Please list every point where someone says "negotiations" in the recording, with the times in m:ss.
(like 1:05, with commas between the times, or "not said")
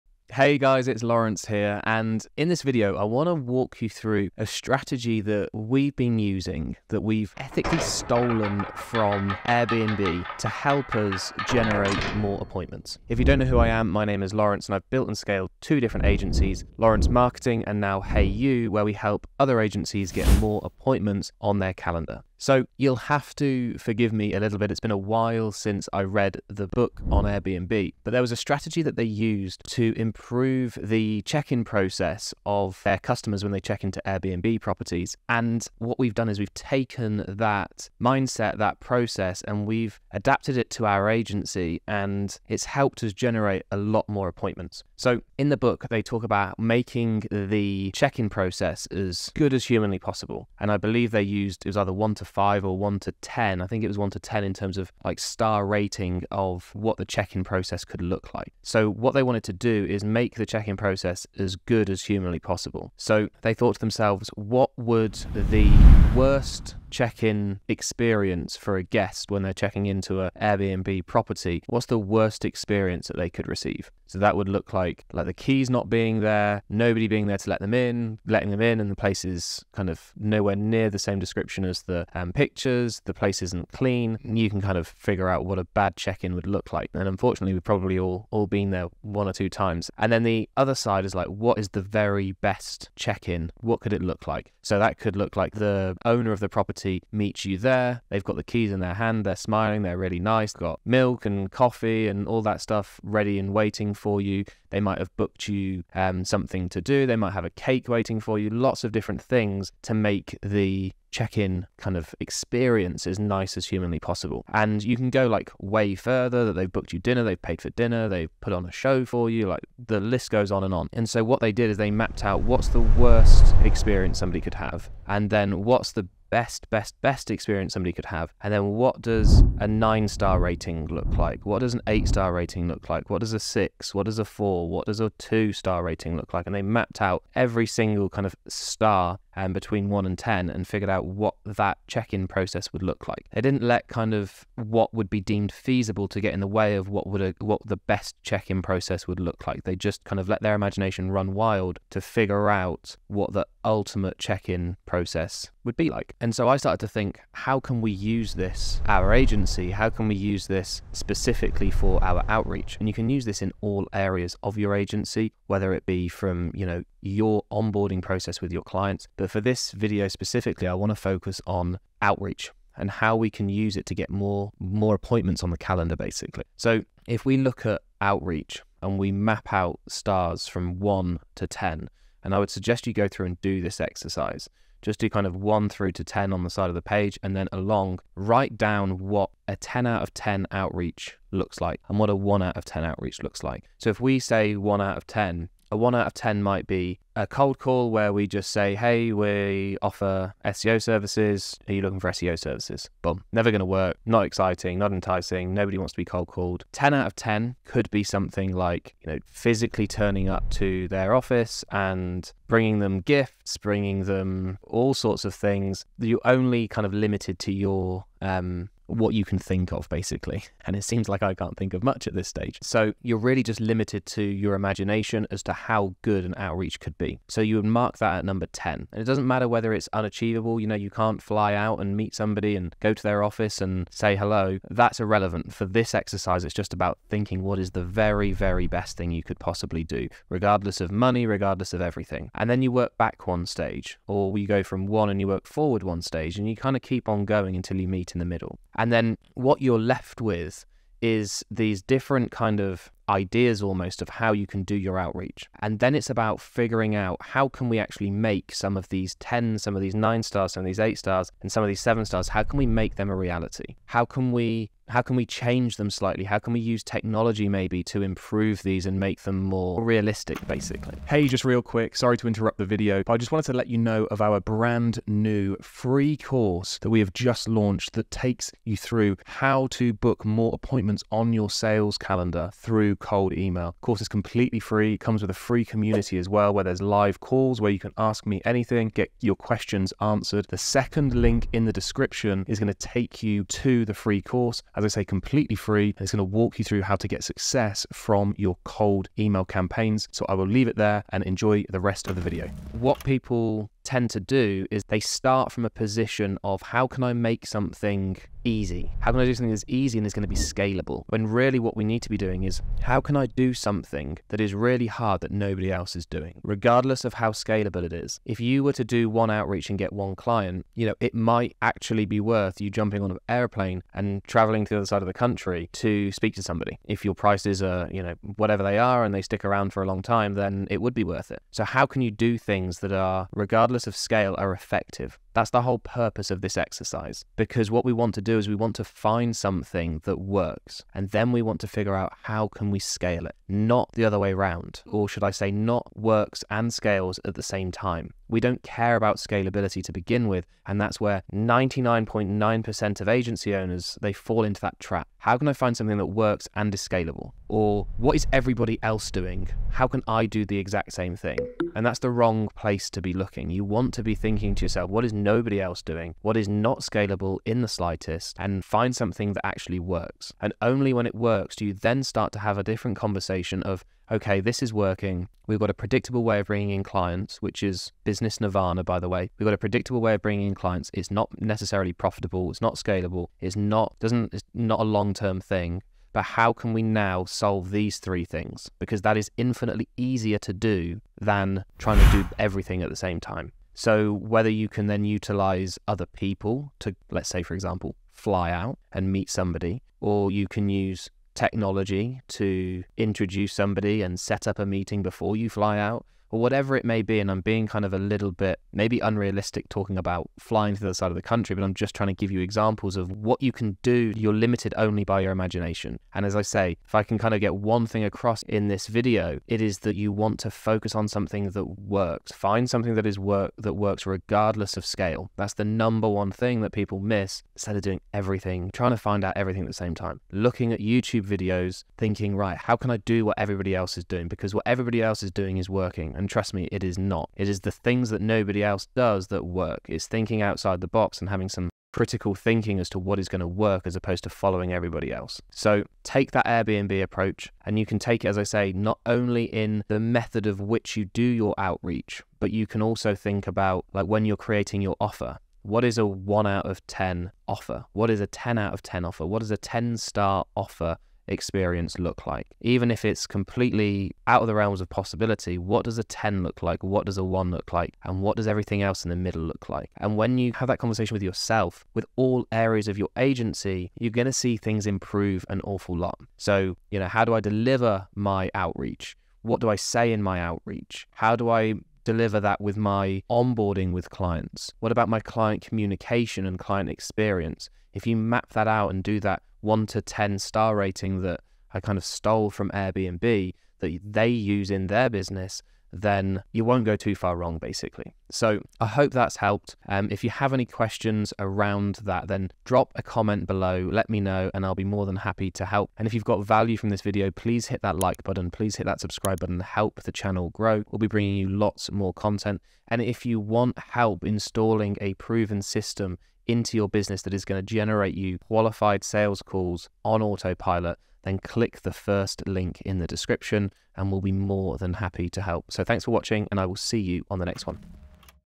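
not said.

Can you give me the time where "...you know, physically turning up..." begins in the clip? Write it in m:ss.
3:29.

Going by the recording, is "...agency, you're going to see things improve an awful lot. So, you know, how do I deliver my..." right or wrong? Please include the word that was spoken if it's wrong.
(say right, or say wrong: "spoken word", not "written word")
right.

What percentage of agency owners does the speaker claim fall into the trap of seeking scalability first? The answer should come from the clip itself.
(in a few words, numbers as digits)
99.9%.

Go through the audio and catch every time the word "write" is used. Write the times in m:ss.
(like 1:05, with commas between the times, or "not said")
3:08.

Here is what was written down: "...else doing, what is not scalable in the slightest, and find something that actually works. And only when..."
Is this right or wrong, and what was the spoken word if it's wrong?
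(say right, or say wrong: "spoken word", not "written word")
right.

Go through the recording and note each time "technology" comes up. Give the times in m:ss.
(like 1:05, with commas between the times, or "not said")
4:26, 6:41.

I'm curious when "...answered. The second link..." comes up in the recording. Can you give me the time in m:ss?
4:50.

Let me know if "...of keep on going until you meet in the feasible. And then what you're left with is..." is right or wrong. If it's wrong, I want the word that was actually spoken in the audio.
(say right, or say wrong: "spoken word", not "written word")
wrong: "middle", not "feasible".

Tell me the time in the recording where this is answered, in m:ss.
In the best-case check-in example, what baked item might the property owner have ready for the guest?
1:47.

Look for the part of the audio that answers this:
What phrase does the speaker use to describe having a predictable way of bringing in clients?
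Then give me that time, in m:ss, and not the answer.
6:18.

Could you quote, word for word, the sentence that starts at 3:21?
Are you looking for SEO services?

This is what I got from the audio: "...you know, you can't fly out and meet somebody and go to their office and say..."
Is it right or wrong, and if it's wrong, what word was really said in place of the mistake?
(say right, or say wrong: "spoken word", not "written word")
right.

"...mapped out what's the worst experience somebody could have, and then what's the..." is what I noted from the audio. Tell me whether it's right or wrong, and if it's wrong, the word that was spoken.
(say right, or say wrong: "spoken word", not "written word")
right.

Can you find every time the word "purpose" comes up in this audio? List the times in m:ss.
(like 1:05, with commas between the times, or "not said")
5:35.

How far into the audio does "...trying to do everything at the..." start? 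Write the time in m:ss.
6:31.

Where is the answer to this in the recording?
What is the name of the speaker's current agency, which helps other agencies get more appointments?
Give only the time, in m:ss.
0:17.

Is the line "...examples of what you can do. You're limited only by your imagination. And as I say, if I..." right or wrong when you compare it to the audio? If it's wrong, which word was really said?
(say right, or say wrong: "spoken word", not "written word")
right.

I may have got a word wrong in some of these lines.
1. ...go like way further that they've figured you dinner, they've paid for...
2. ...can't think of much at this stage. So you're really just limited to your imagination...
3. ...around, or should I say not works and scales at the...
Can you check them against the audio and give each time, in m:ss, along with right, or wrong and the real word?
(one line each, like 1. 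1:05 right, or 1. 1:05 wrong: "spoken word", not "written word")
1. 1:55 wrong: "booked", not "figured"
2. 3:41 right
3. 5:44 right.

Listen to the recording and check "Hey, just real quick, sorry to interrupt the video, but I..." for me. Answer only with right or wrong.
right.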